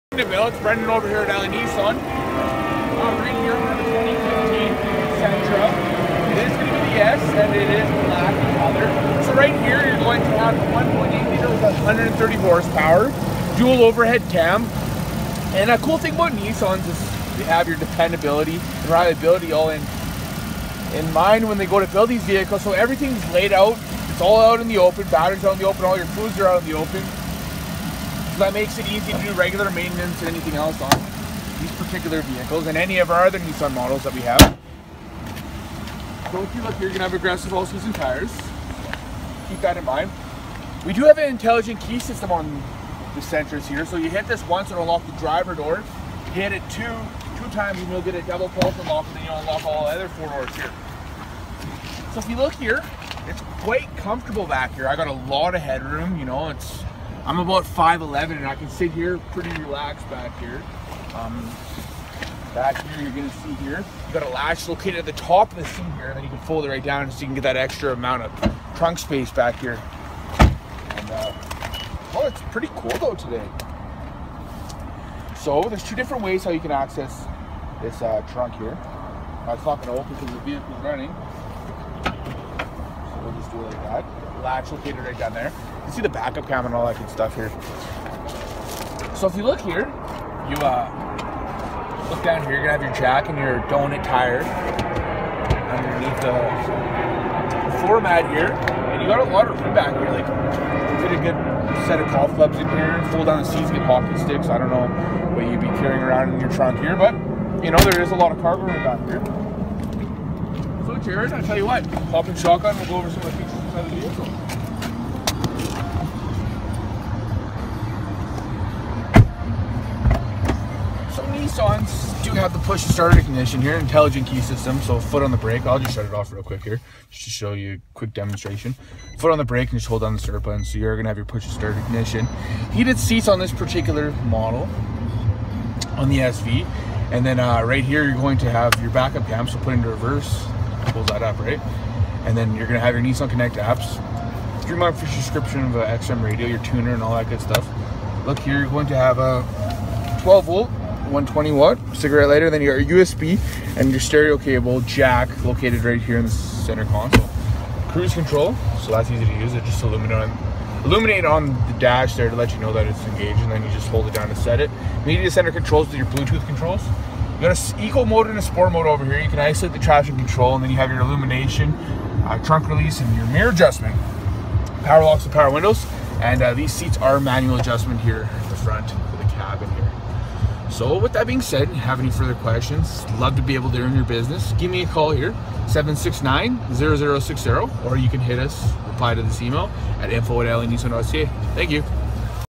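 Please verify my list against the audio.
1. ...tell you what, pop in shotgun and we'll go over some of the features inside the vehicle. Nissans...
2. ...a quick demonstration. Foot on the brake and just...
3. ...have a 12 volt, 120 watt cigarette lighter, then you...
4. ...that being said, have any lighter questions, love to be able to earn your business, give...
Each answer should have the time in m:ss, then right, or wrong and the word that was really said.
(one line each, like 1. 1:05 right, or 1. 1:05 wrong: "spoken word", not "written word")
1. 1:51 right
2. 2:07 right
3. 2:28 right
4. 3:01 wrong: "further", not "lighter".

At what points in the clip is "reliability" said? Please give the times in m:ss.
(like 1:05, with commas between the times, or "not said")
0:18.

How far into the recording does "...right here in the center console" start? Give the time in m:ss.
2:35.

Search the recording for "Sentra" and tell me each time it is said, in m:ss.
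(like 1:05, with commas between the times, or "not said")
0:05, 0:43.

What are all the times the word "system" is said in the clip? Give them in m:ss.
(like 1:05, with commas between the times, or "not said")
0:41, 2:04.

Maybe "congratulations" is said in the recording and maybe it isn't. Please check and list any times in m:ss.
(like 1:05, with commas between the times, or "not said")
not said.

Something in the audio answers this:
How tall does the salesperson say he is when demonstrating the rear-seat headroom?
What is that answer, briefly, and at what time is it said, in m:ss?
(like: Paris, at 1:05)
5'11, at 0:57.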